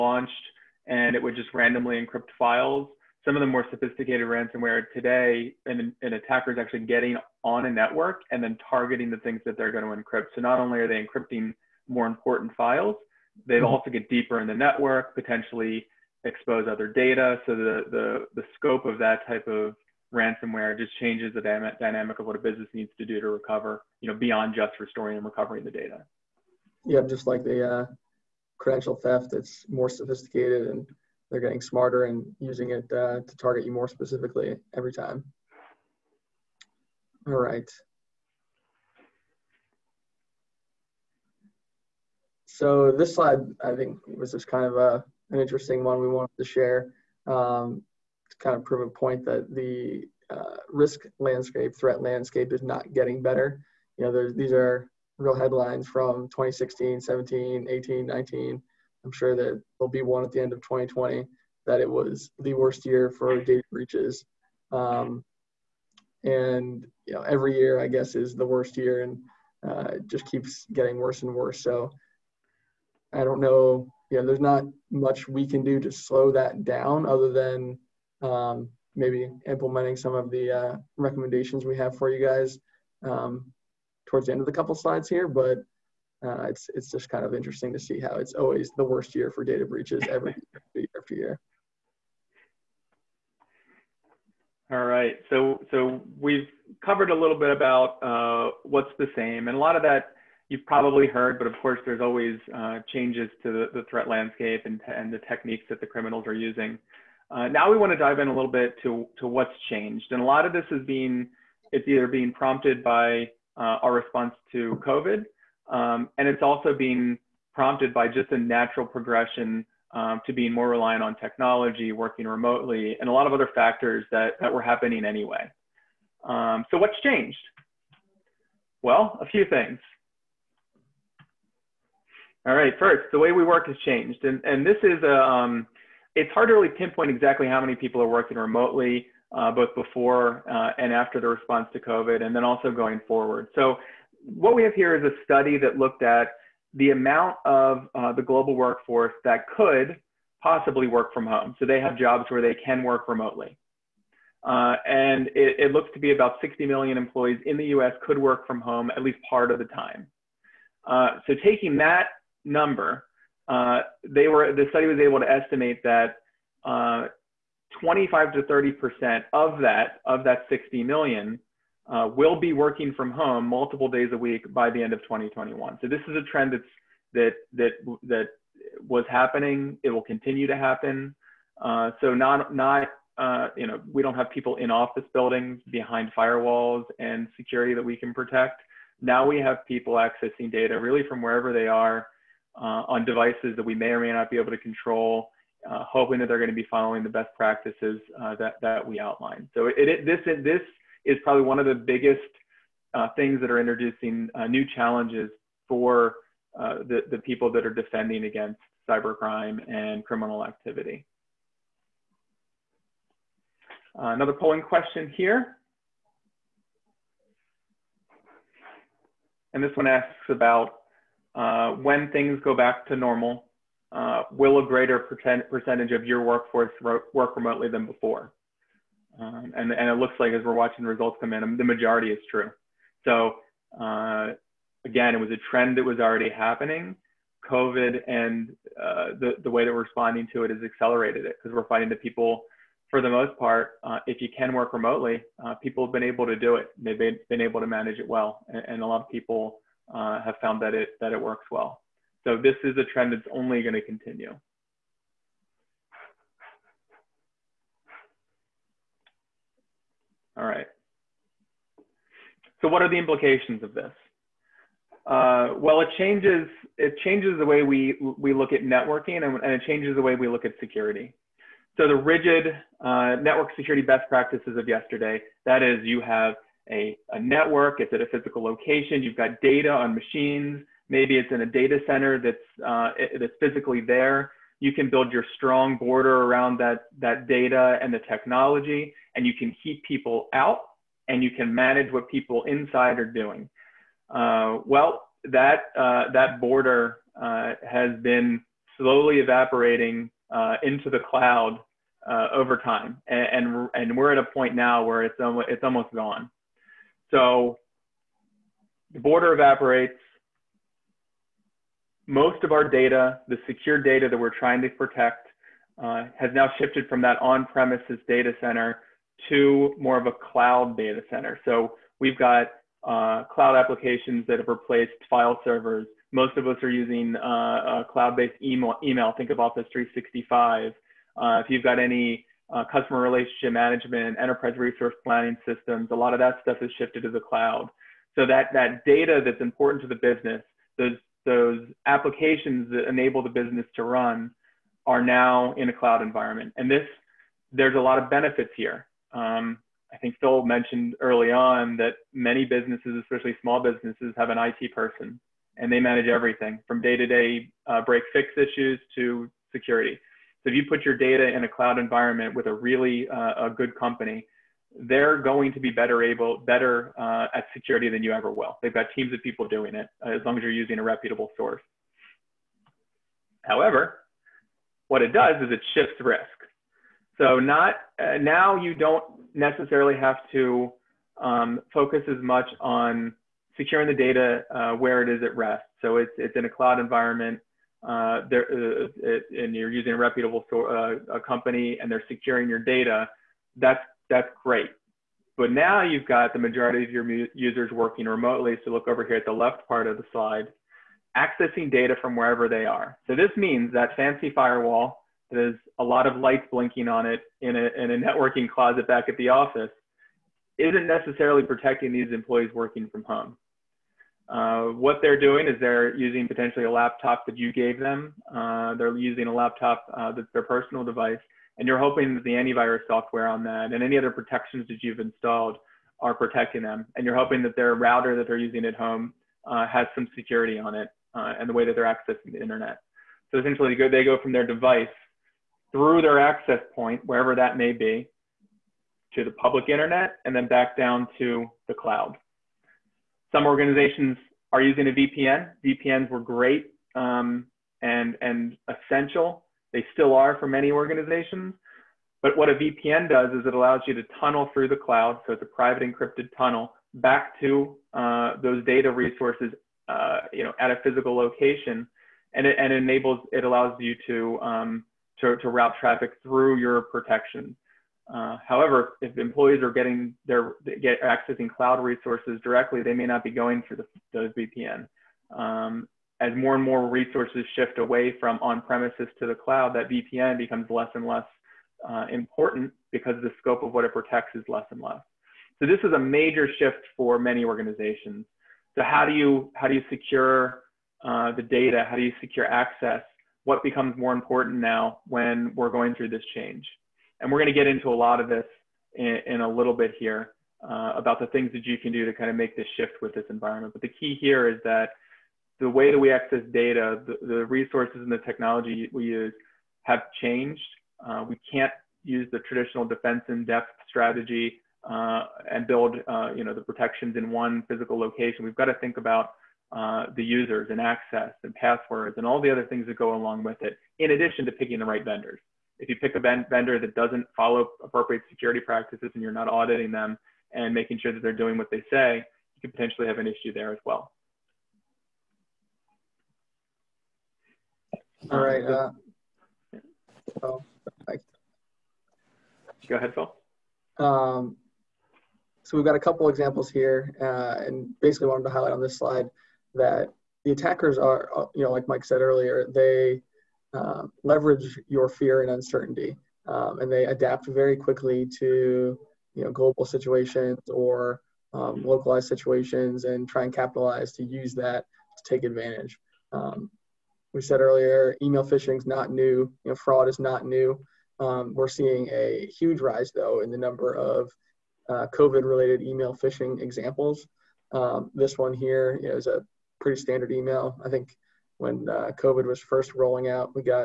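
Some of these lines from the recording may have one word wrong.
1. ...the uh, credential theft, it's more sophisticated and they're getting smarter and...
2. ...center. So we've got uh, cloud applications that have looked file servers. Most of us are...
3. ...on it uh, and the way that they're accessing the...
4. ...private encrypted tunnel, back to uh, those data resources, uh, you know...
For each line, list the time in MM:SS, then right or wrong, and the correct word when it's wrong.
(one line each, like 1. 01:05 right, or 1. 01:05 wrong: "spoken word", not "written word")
1. 00:27 right
2. 05:21 wrong: "replaced", not "looked"
3. 07:10 right
4. 07:35 right.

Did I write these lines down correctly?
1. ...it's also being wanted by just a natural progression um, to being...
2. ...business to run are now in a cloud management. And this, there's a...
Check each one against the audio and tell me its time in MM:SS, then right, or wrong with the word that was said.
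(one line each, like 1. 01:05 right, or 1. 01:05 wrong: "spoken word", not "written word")
1. 01:56 wrong: "prompted", not "wanted"
2. 05:43 wrong: "environment", not "management".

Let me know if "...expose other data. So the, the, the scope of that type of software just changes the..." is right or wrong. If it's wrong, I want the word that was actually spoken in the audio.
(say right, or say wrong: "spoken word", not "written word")
wrong: "ransomware", not "software".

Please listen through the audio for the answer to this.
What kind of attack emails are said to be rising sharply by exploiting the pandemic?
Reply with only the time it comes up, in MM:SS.
09:35.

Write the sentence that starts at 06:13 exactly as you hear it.
However, what it does is it shifts risk.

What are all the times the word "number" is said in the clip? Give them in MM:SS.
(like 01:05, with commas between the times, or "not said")
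02:42, 09:33.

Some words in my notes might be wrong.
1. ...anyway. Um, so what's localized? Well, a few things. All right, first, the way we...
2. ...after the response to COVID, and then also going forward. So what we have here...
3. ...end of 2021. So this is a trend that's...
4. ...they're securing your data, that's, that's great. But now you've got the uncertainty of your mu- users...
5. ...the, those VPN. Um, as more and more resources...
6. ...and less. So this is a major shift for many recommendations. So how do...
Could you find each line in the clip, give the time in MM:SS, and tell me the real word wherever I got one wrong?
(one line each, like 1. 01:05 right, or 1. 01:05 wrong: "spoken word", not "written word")
1. 02:05 wrong: "changed", not "localized"
2. 02:20 right
3. 02:54 right
4. 06:31 wrong: "majority", not "uncertainty"
5. 07:53 right
6. 08:04 wrong: "organizations", not "recommendations".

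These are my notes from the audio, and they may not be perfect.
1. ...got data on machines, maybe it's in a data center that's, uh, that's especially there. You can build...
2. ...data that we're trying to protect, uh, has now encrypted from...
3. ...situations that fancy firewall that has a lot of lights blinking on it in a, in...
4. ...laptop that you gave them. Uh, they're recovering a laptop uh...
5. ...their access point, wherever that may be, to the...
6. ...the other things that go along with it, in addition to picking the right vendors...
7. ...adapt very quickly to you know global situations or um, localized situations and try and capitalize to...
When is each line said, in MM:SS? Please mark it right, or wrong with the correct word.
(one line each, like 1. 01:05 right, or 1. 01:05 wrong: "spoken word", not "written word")
1. 04:39 wrong: "physically", not "especially"
2. 05:13 wrong: "shifted", not "encrypted"
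3. 06:43 wrong: "means", not "situations"
4. 06:56 wrong: "using", not "recovering"
5. 07:16 right
6. 08:42 right
7. 09:17 right.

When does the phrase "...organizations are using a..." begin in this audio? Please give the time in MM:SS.
07:23.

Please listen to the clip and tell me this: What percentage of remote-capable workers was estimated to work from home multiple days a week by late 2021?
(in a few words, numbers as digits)
25 to 30 percent.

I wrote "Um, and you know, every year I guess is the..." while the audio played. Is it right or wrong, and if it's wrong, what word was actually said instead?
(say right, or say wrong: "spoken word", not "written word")
right.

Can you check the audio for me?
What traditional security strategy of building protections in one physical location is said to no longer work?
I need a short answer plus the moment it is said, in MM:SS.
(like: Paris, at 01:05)
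defense in depth, at 08:32.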